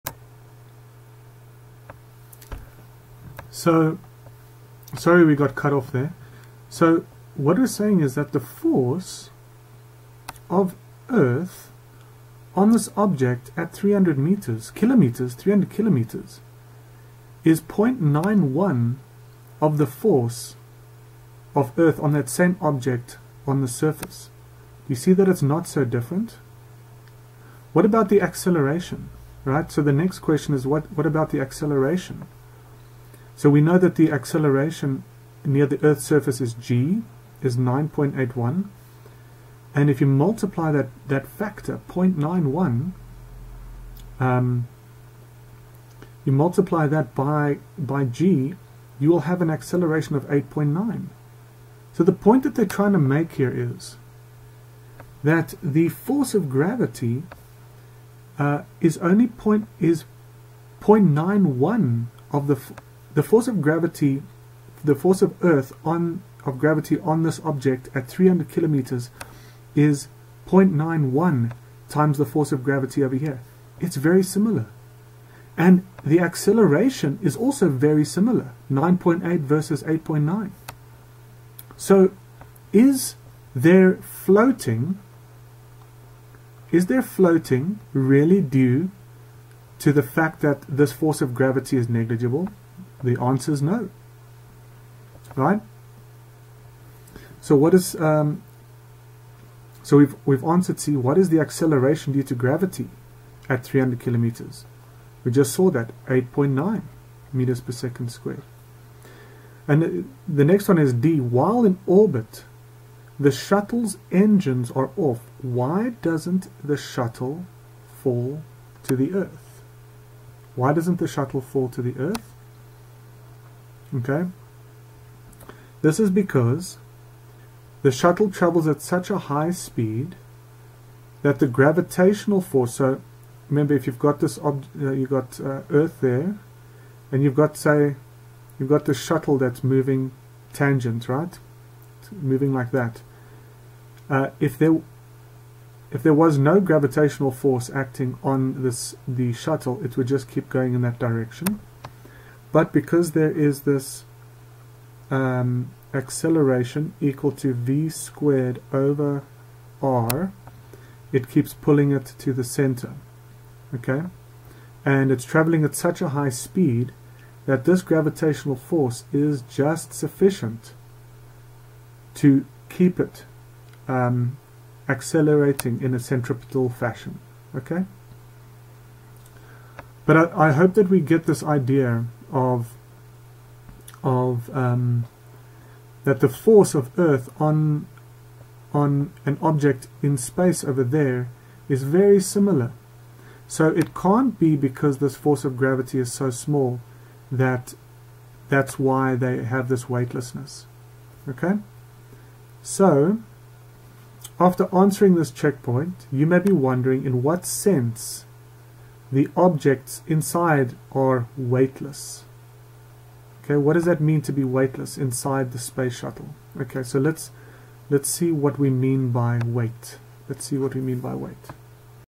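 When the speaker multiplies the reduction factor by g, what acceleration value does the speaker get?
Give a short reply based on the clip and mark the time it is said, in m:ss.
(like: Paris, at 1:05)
8.9, at 0:49.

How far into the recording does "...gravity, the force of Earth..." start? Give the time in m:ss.
1:03.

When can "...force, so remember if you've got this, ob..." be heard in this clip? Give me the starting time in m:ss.
2:12.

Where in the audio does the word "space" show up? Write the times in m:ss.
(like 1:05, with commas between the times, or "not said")
3:10, 3:35.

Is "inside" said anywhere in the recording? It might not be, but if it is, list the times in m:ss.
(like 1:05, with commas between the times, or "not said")
3:30, 3:34.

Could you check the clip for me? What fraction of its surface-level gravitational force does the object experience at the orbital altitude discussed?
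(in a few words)
0.91.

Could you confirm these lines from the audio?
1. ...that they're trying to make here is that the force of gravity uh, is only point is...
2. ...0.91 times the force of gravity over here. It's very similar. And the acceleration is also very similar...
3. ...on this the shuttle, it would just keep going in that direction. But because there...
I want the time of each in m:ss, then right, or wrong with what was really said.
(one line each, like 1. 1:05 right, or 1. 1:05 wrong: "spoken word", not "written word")
1. 0:52 right
2. 1:10 right
3. 2:28 right.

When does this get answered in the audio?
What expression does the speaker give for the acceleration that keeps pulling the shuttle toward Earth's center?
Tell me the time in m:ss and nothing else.
2:37.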